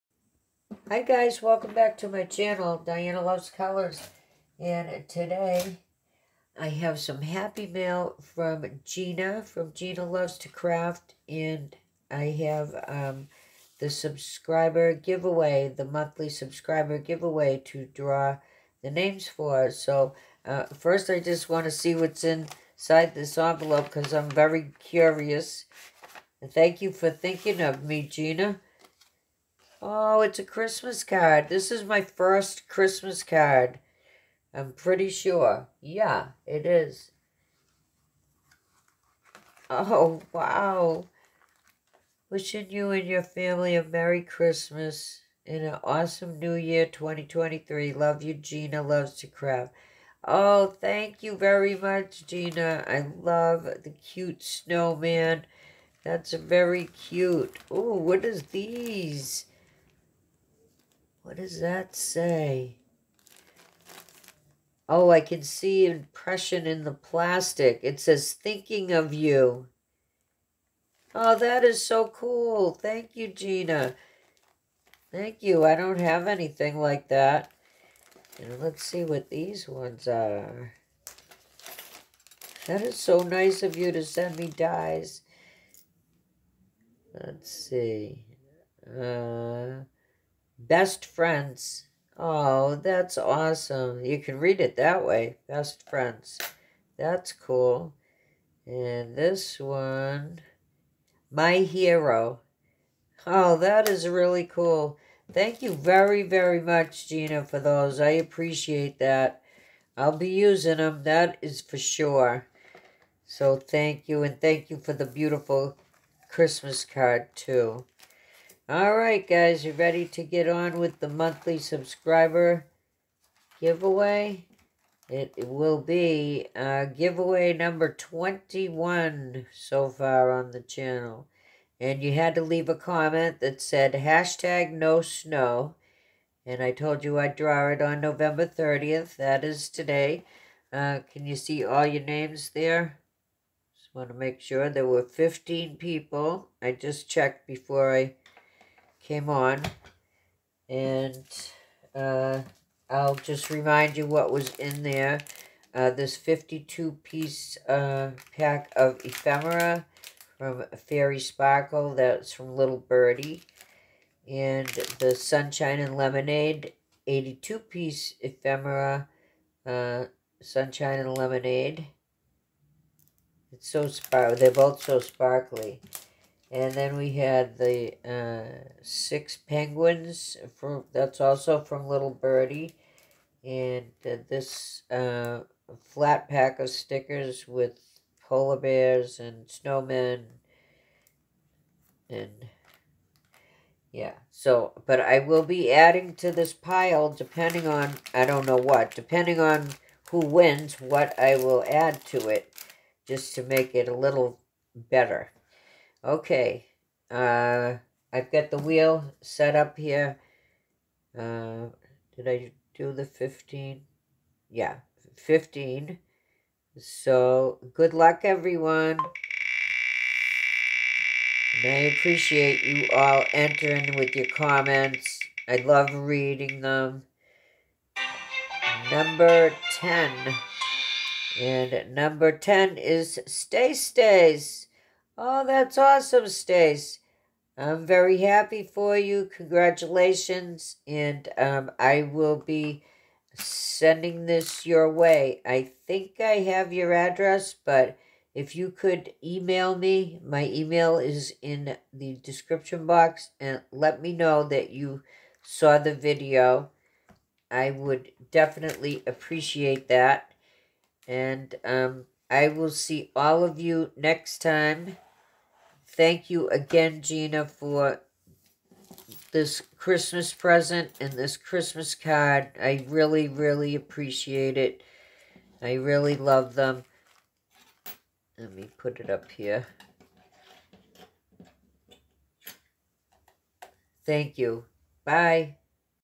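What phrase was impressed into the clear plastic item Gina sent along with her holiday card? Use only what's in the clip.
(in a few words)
Thinking of you.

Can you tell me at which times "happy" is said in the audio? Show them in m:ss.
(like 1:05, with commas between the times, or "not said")
0:07, 3:58.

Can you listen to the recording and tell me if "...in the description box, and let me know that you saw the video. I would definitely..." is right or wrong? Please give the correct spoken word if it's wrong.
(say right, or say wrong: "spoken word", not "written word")
right.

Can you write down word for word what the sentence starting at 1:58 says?
All right, guys, you ready to get on with the monthly subscriber giveaway?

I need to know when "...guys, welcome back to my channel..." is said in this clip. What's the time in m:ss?
0:01.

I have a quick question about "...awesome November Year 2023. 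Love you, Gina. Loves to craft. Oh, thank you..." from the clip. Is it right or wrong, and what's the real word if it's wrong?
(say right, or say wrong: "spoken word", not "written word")
wrong: "New", not "November".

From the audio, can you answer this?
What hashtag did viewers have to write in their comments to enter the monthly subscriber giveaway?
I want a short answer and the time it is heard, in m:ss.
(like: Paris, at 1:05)
No snow, at 2:14.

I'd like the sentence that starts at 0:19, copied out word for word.
So uh, first I just want to see what's inside this envelope because I'm very curious.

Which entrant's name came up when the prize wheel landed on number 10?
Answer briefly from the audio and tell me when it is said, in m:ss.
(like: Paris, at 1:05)
StaceStace, at 3:53.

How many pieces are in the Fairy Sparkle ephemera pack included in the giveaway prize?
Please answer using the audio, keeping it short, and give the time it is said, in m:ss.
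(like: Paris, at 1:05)
52, at 2:36.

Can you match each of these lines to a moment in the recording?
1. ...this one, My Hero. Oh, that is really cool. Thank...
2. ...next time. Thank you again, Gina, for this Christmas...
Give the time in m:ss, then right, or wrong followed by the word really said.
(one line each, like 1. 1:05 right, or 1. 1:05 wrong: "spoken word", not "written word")
1. 1:39 right
2. 4:23 right.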